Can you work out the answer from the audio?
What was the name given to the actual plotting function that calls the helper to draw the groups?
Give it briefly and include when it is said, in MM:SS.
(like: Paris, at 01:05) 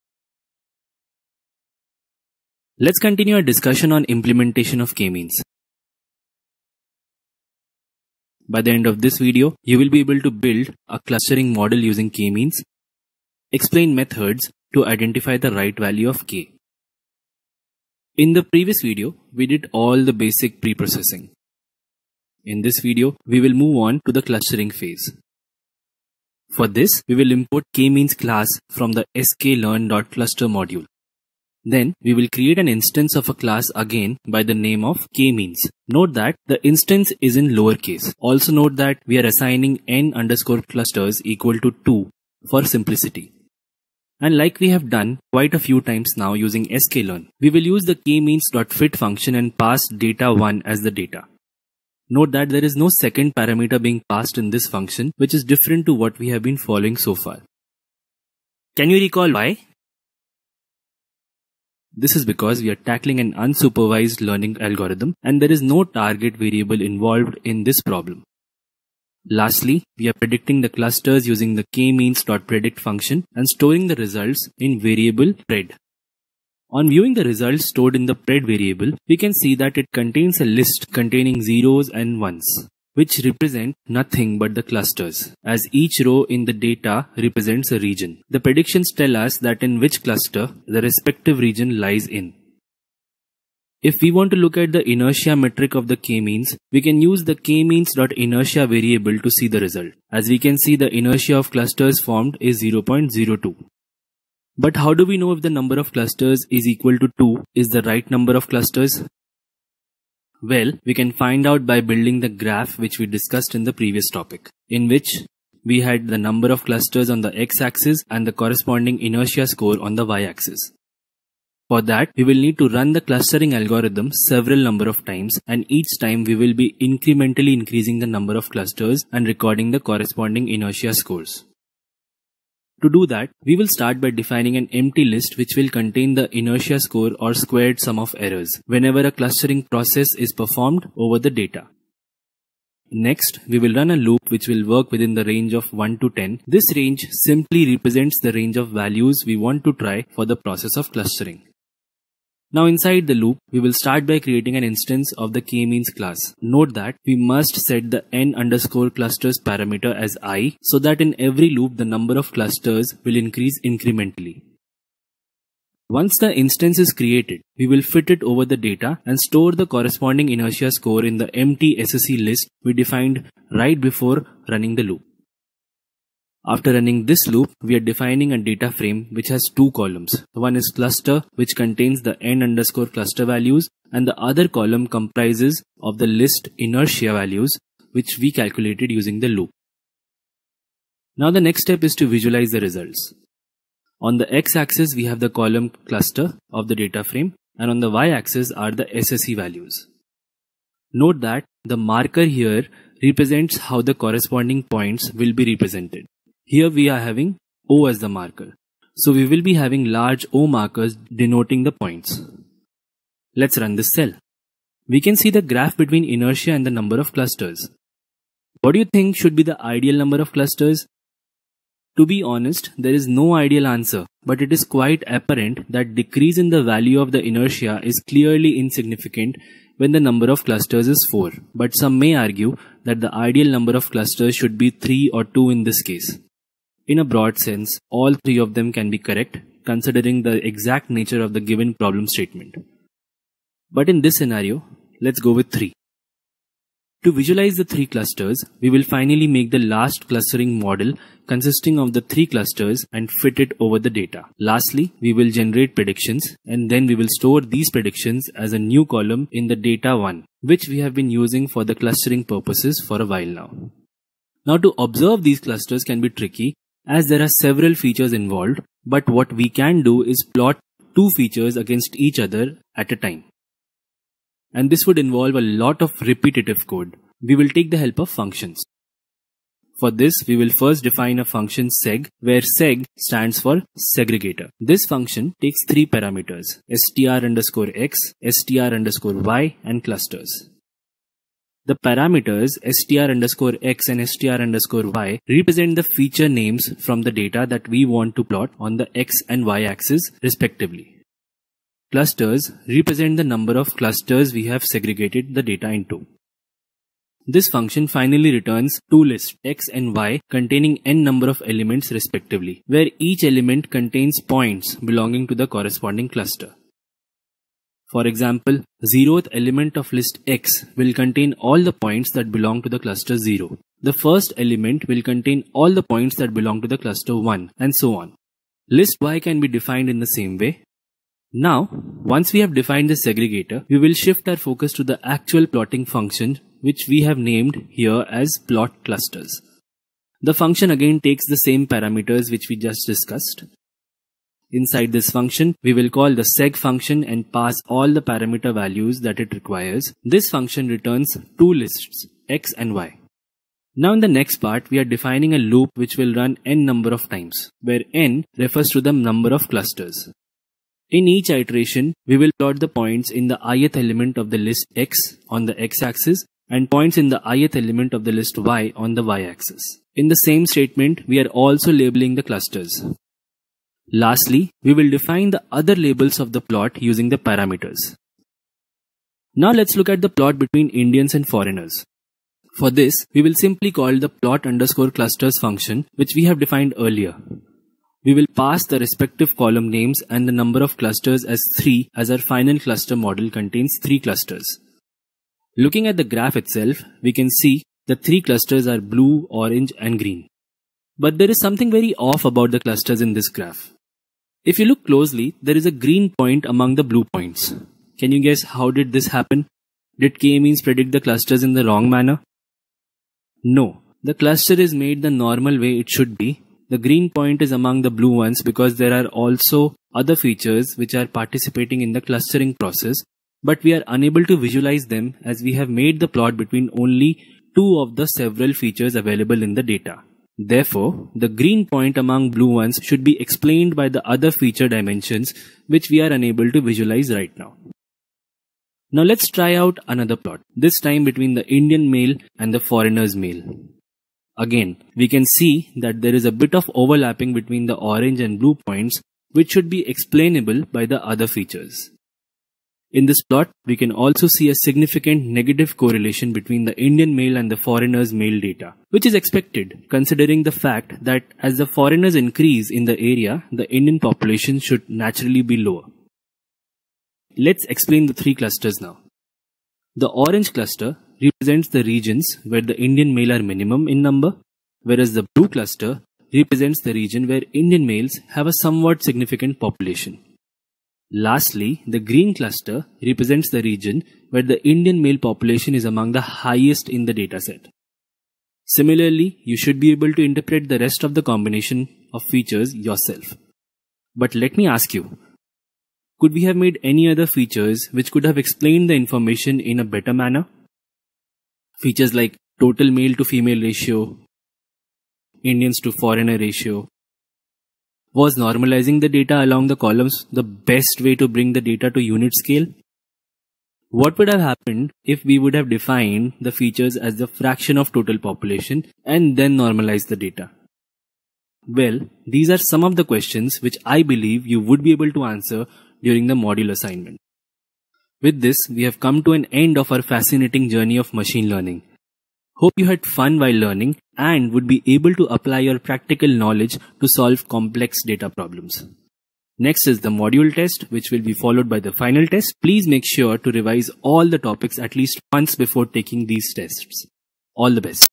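plot clusters, at 05:38.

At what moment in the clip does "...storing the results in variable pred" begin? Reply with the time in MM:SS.
01:13.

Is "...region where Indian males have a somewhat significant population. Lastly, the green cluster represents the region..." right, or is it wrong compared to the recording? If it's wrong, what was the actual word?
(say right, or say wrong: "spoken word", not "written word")
right.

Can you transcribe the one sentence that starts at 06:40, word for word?
But there is something very off about the clusters in this graph.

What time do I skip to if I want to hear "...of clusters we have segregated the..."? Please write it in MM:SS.
05:03.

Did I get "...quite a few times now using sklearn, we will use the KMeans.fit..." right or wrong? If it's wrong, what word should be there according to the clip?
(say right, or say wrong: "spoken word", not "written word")
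right.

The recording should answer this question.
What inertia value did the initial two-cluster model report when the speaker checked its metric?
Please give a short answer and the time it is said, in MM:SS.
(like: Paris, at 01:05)
0.02, at 01:42.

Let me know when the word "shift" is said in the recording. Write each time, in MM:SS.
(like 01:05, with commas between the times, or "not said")
05:33.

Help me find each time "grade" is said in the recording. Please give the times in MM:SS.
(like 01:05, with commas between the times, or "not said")
not said.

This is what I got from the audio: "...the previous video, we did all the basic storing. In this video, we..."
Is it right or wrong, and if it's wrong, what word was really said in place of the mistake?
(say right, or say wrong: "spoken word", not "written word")
wrong: "preprocessing", not "storing".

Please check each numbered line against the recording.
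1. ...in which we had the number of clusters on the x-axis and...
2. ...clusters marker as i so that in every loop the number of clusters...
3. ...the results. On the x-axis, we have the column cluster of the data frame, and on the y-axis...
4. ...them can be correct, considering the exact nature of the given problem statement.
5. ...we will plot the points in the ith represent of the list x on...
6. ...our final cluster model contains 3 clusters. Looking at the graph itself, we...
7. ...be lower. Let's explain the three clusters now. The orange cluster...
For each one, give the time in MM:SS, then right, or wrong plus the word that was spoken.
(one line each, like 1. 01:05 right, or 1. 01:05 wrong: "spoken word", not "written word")
1. 01:54 right
2. 02:38 wrong: "parameter", not "marker"
3. 03:12 right
4. 03:58 right
5. 06:02 wrong: "element", not "represent"
6. 06:32 right
7. 07:45 right.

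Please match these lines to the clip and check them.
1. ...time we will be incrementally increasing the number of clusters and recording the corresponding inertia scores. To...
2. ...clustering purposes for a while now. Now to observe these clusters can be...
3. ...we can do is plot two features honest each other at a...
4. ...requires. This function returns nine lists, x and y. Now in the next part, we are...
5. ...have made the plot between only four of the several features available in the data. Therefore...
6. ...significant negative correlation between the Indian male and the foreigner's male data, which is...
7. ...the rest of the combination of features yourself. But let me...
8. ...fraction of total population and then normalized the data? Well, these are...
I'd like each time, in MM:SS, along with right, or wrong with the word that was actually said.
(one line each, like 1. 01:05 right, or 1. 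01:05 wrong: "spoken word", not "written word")
1. 02:05 right
2. 04:21 right
3. 04:29 wrong: "against", not "honest"
4. 05:49 wrong: "two", not "nine"
5. 07:05 wrong: "two", not "four"
6. 07:34 right
7. 08:10 right
8. 08:37 right.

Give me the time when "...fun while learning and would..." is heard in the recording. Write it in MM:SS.
08:53.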